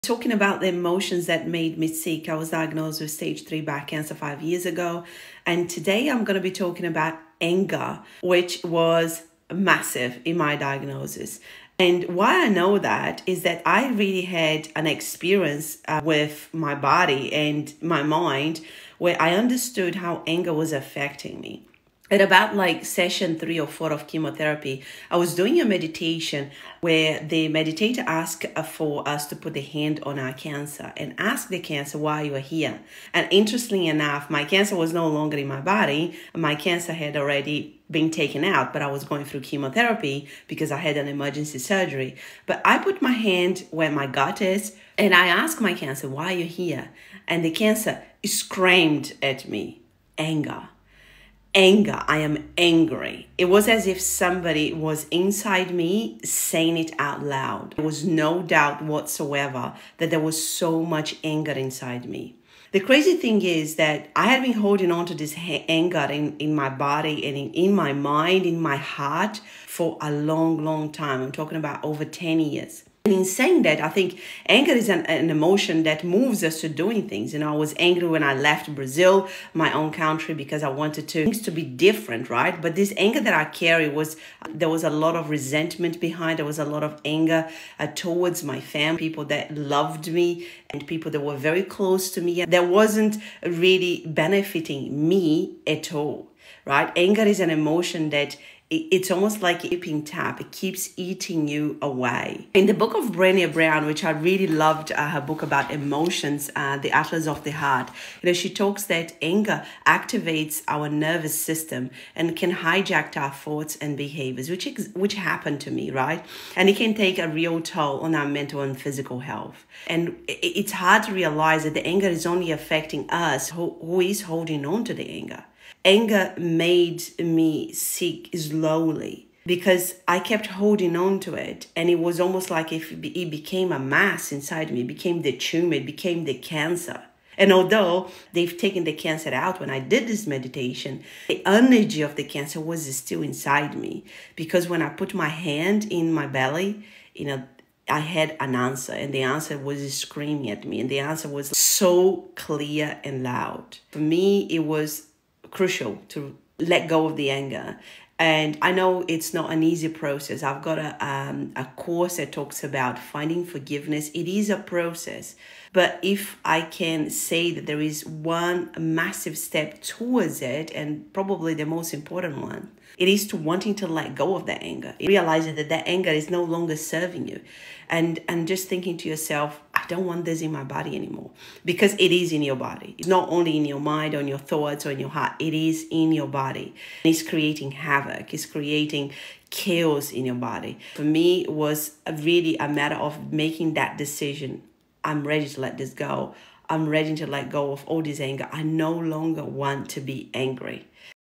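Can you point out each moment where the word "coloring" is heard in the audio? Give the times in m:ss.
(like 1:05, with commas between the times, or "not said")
not said.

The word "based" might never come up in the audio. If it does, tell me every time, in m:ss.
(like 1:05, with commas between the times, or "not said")
not said.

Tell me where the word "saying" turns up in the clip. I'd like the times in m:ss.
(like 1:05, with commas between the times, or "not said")
0:56, 1:13.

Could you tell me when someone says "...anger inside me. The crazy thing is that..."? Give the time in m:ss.
1:01.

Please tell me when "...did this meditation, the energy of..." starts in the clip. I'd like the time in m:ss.
2:19.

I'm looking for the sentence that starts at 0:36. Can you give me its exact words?
My cancer had already been taken out, but I was going through chemotherapy because I had an emergency surgery.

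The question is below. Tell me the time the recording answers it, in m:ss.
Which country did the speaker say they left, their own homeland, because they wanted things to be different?
1:18.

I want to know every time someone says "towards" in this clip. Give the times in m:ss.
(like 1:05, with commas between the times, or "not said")
1:27, 2:49.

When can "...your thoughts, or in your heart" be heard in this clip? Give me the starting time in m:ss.
3:04.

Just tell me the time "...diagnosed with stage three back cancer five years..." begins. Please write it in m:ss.
0:02.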